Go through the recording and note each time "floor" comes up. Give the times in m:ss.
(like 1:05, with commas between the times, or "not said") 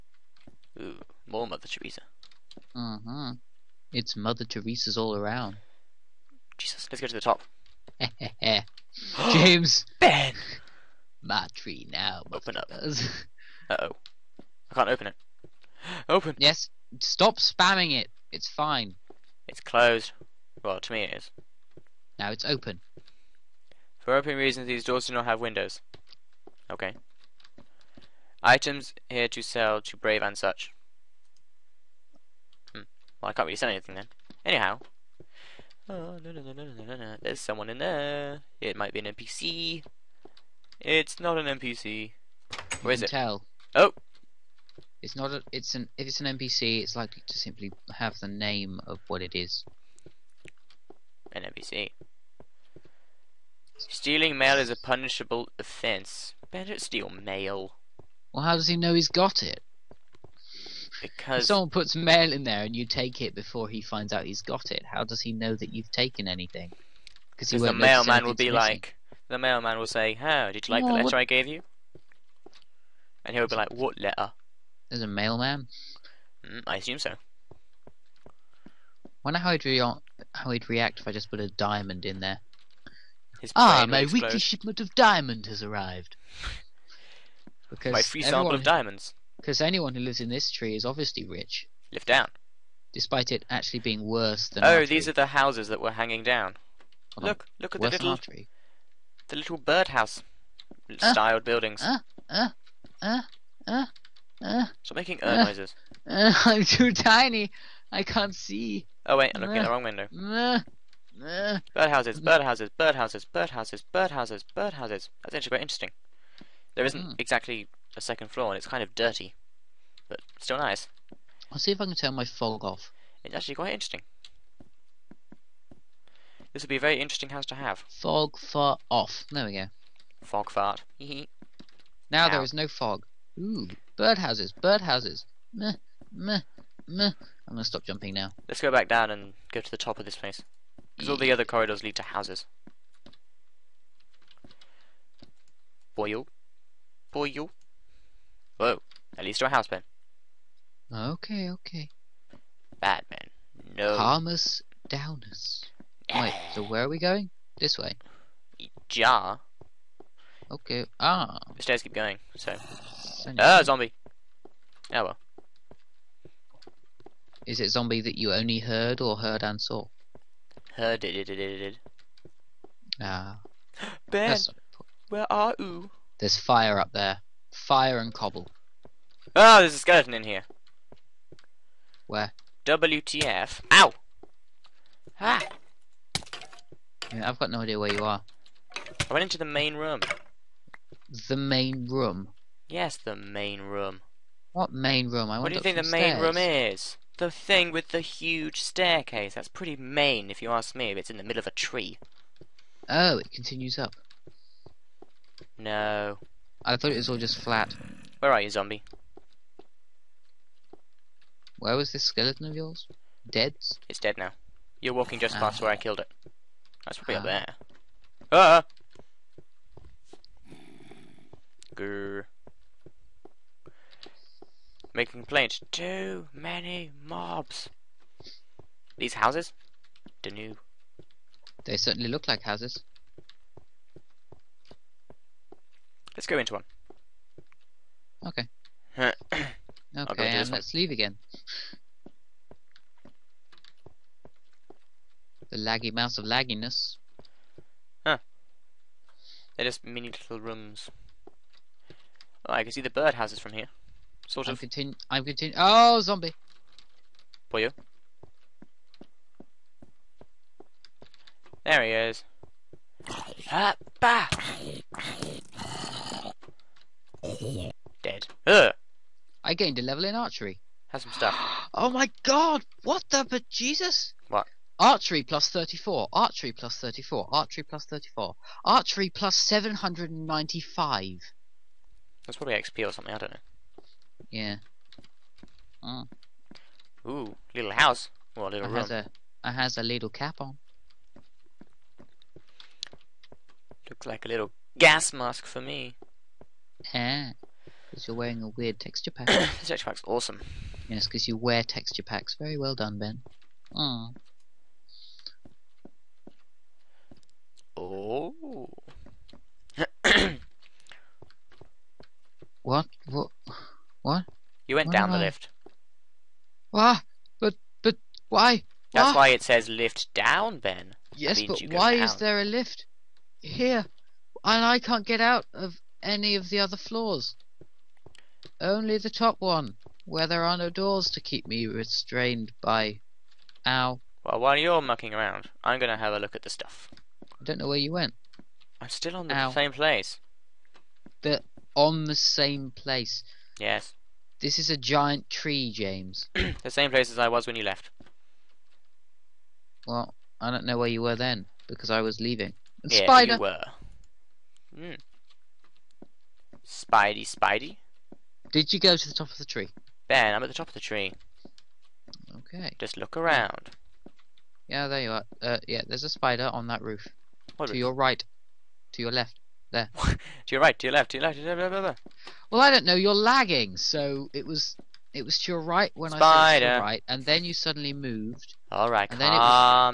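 1:58, 5:26.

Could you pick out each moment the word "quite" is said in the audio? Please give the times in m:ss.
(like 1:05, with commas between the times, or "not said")
1:55, 2:03.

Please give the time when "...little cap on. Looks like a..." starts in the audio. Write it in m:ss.
4:49.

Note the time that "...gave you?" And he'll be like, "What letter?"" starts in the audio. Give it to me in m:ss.
1:11.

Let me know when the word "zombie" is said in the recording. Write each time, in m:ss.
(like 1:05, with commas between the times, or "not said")
2:43, 2:47, 3:28, 4:16.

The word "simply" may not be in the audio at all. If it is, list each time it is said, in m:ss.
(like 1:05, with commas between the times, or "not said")
0:47.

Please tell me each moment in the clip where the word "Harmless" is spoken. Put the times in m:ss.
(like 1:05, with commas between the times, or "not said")
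2:33.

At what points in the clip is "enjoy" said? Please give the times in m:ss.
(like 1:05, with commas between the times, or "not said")
not said.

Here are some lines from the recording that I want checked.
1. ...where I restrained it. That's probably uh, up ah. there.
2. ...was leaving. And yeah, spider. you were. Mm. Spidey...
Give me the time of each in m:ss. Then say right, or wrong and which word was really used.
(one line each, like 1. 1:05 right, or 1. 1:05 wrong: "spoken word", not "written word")
1. 3:35 wrong: "killed", not "restrained"
2. 5:52 right.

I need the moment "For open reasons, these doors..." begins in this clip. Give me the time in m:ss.
0:23.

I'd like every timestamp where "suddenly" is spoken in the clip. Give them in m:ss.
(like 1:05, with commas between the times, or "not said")
6:17.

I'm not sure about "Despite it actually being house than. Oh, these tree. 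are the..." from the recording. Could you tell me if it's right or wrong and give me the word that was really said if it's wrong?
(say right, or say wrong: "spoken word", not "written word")
wrong: "worse", not "house".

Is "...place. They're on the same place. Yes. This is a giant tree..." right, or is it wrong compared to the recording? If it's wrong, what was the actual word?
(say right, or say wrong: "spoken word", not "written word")
right.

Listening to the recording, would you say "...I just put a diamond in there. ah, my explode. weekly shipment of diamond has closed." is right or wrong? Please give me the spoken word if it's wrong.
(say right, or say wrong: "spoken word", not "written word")
wrong: "arrived", not "closed".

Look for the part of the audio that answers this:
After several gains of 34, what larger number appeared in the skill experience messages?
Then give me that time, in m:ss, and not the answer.
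4:38.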